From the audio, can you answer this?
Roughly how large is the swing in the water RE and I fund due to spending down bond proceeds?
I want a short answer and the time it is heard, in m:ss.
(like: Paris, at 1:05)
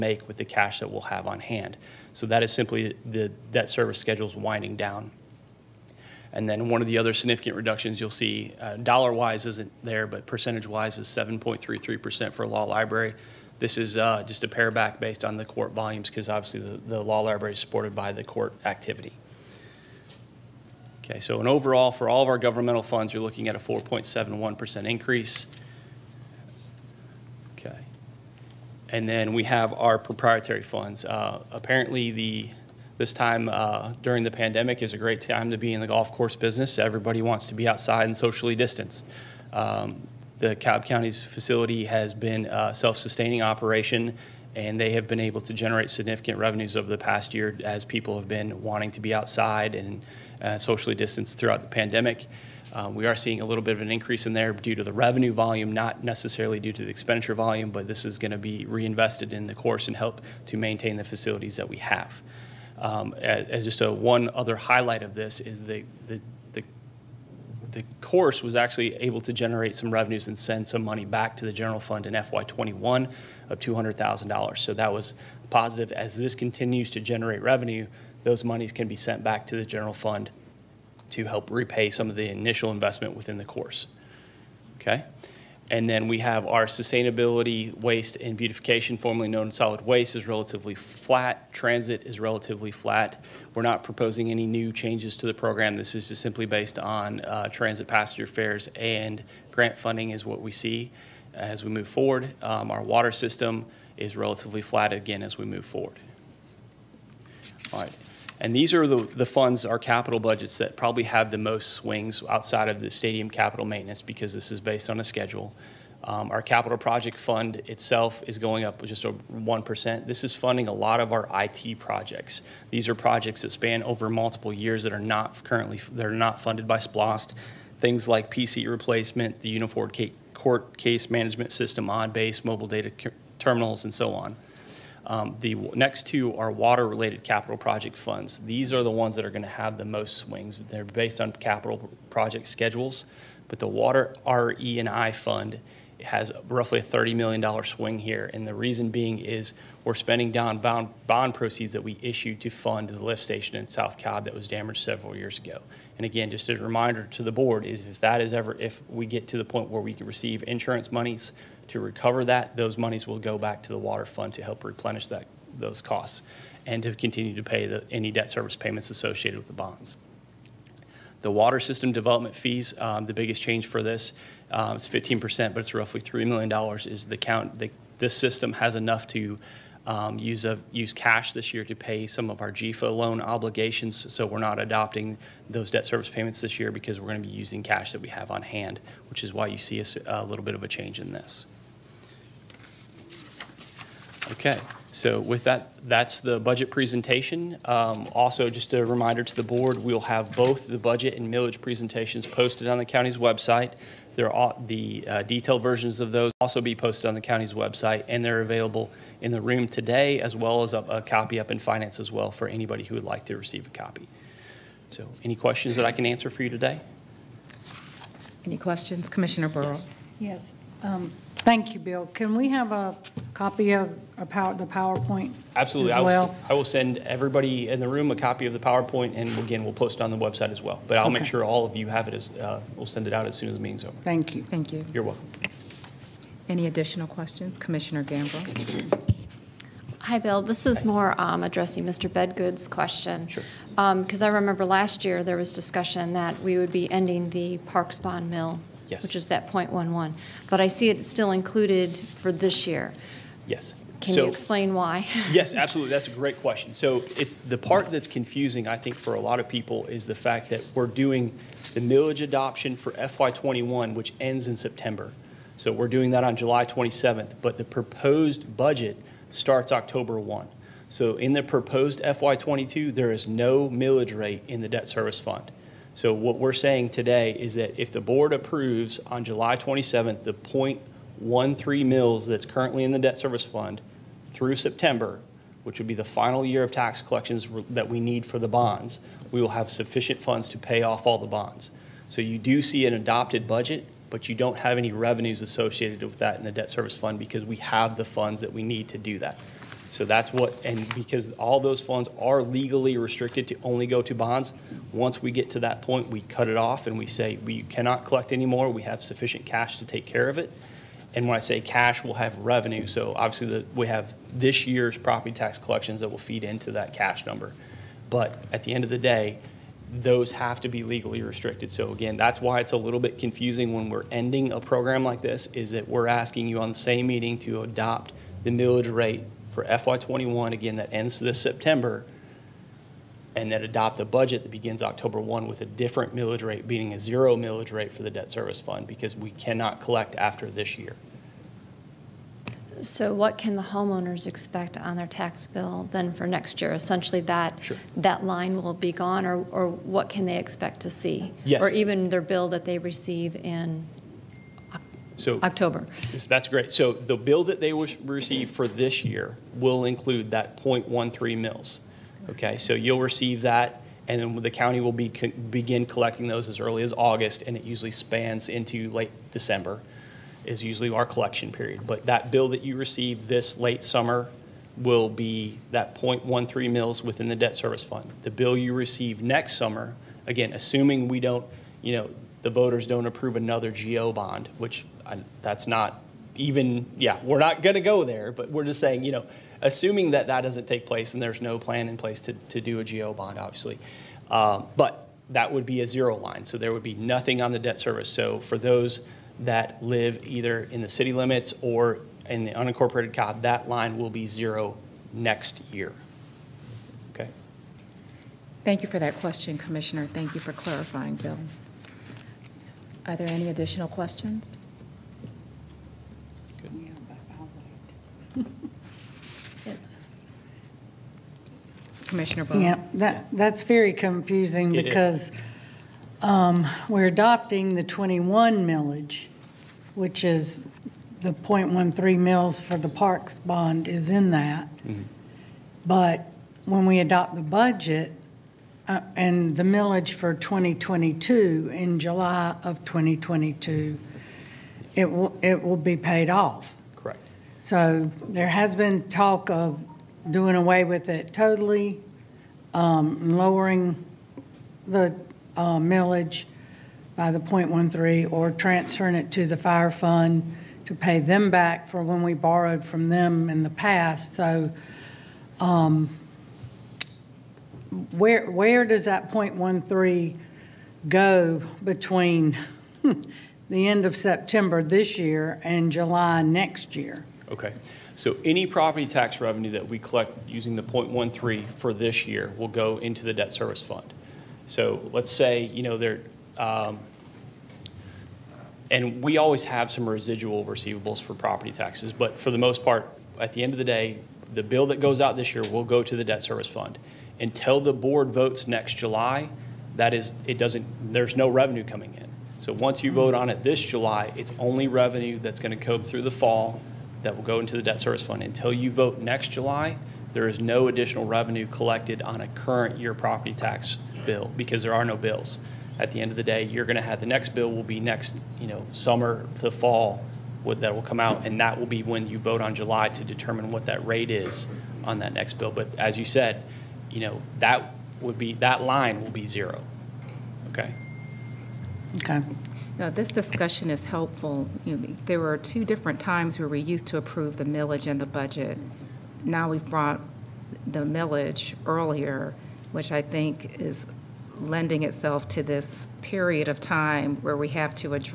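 $30 million, at 2:26.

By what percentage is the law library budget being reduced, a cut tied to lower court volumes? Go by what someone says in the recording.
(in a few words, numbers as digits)
7.33%.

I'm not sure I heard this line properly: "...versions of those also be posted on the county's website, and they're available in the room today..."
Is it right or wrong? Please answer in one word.
right.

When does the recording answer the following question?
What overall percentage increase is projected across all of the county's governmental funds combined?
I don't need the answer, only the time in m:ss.
0:23.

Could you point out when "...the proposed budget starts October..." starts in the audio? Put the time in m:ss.
4:27.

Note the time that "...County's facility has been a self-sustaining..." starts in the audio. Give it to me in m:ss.
0:40.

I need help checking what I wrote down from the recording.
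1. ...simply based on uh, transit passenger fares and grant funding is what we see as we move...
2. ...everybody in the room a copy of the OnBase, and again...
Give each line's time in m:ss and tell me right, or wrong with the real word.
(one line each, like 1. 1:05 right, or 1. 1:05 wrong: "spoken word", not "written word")
1. 1:36 right
2. 3:46 wrong: "PowerPoint", not "OnBase".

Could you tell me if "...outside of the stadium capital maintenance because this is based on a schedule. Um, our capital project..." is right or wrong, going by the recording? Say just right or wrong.
right.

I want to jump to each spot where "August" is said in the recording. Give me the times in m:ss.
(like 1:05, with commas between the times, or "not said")
6:06.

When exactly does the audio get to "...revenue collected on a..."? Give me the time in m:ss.
8:31.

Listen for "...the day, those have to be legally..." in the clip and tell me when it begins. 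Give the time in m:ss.
5:18.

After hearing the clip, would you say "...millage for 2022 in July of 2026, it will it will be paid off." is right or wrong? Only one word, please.
wrong.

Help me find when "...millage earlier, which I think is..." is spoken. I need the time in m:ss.
9:01.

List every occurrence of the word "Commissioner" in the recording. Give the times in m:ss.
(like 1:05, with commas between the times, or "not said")
3:39, 3:57, 6:49, 7:02.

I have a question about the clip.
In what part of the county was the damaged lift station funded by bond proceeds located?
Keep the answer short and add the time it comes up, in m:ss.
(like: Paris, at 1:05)
South Cobb, at 2:33.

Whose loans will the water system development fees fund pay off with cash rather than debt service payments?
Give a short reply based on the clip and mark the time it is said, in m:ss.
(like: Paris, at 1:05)
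GEFA, at 3:02.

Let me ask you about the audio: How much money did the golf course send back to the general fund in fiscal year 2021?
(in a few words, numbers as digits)
$200,000.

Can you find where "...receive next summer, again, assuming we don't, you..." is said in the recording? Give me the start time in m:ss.
6:18.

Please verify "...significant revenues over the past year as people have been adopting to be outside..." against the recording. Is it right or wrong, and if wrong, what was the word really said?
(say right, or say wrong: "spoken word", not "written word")
wrong: "wanting", not "adopting".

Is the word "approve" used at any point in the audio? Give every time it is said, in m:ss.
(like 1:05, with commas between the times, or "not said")
4:38, 6:23, 8:57.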